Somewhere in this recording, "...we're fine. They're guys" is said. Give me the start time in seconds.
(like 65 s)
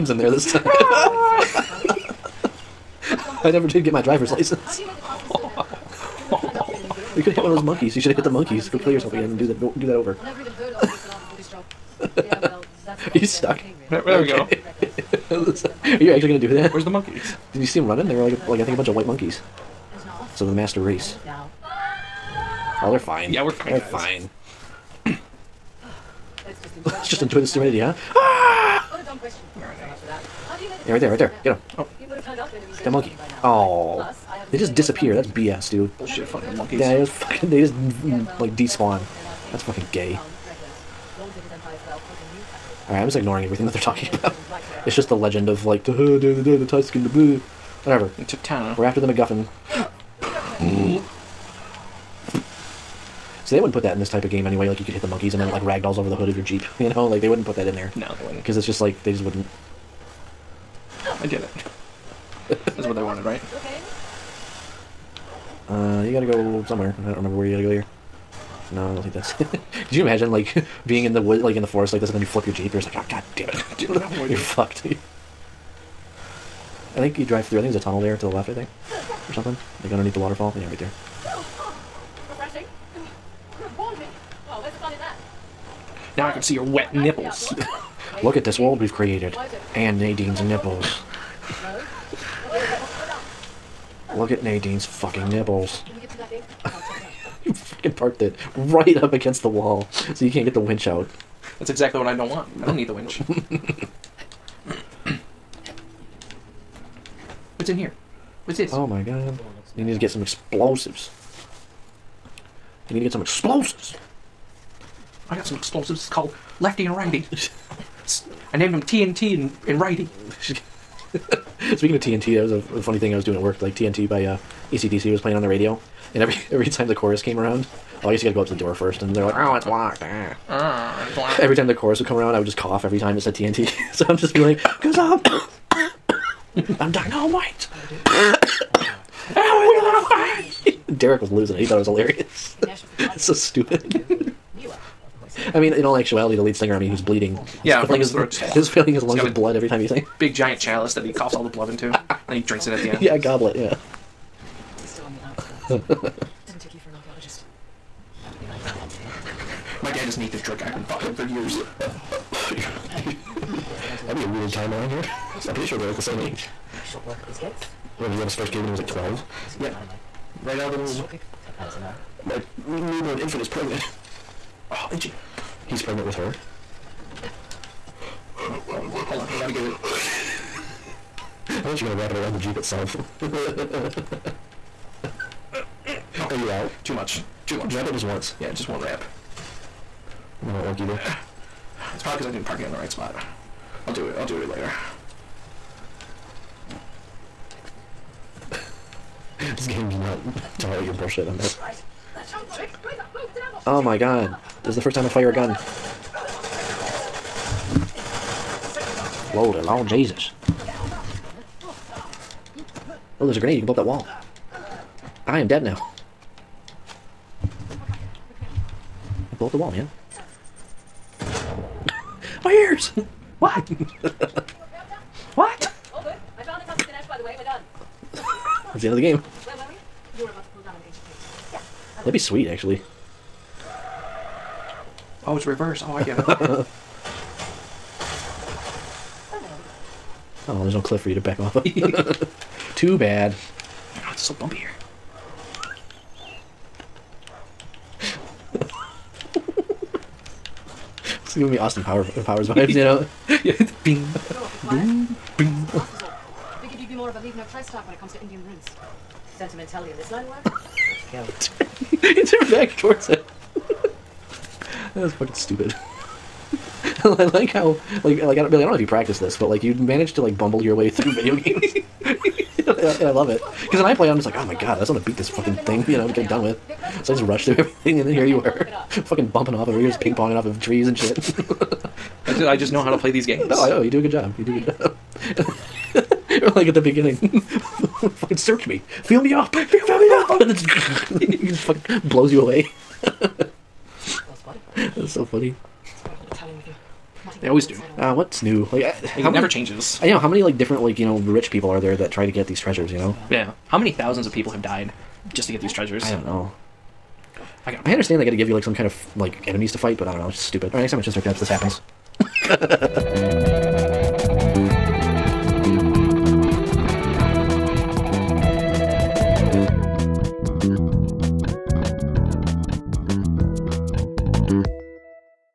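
23 s.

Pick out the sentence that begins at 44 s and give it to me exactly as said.
It's just the legend of like the the, the, the the Whatever.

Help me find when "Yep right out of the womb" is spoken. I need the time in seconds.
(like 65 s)
169 s.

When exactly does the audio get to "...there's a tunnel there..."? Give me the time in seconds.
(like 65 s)
77 s.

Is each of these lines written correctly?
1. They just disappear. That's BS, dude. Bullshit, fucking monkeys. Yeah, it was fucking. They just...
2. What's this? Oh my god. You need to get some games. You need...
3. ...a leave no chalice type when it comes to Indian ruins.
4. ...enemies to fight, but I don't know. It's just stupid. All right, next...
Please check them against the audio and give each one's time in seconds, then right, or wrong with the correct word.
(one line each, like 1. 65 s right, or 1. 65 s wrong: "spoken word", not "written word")
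1. 34 s right
2. 108 s wrong: "explosives", not "games"
3. 257 s wrong: "trace", not "chalice"
4. 309 s right.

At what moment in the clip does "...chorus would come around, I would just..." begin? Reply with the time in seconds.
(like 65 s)
131 s.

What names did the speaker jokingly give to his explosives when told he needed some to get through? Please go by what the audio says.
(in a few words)
Lefty and Righty.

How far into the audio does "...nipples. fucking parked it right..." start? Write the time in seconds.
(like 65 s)
95 s.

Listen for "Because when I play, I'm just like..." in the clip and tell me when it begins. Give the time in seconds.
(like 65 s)
273 s.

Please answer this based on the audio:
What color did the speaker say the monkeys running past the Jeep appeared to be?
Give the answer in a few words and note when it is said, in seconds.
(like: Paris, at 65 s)
White, at 18 s.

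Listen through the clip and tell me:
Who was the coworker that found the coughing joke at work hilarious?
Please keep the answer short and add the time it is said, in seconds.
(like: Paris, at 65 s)
Derek, at 140 s.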